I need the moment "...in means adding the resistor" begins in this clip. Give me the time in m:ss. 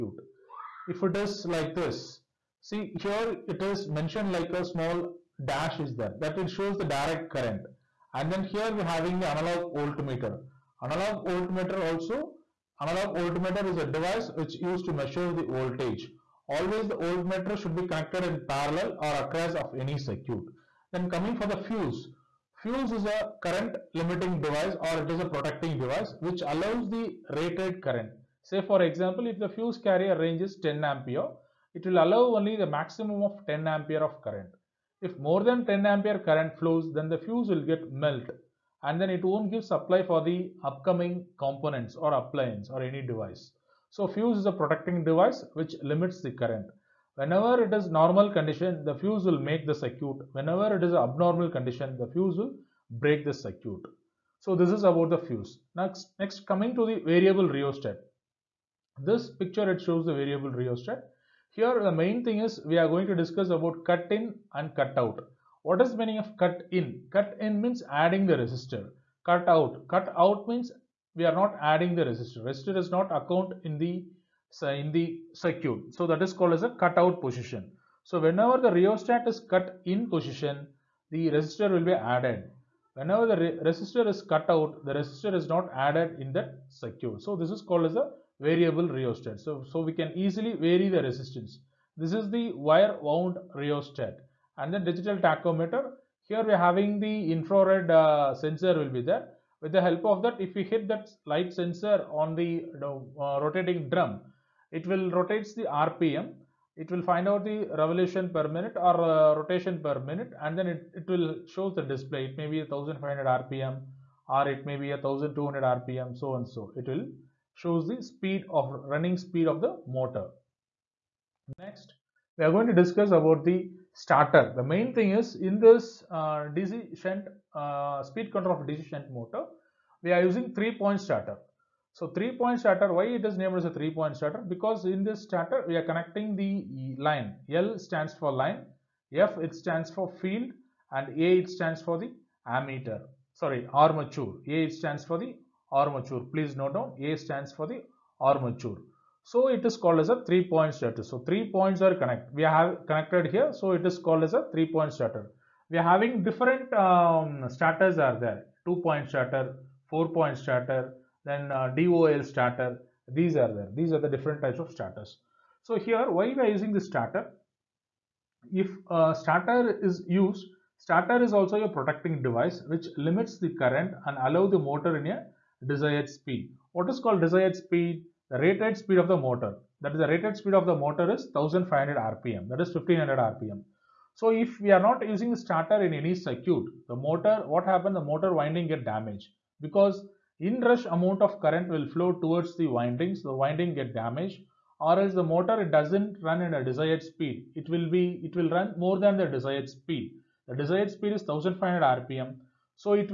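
1:07.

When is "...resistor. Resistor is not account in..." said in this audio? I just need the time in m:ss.
1:12.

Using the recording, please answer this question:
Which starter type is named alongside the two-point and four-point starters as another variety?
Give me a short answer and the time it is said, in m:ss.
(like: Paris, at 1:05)
DOL starter, at 2:41.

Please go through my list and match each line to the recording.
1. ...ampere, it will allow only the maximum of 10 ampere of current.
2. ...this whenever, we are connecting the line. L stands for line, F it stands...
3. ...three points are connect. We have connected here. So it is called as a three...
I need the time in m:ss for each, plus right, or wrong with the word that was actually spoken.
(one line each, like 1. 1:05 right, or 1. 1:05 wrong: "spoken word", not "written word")
1. 0:30 right
2. 2:15 wrong: "starter", not "whenever"
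3. 2:31 right.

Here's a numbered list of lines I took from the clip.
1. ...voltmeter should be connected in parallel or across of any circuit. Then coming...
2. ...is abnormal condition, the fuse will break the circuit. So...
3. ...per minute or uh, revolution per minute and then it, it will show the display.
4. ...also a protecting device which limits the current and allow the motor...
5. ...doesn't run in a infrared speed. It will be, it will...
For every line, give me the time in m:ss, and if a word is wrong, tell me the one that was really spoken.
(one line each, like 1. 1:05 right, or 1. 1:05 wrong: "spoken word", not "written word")
1. 0:16 right
2. 0:50 right
3. 1:48 wrong: "rotation", not "revolution"
4. 2:51 right
5. 3:15 wrong: "desired", not "infrared".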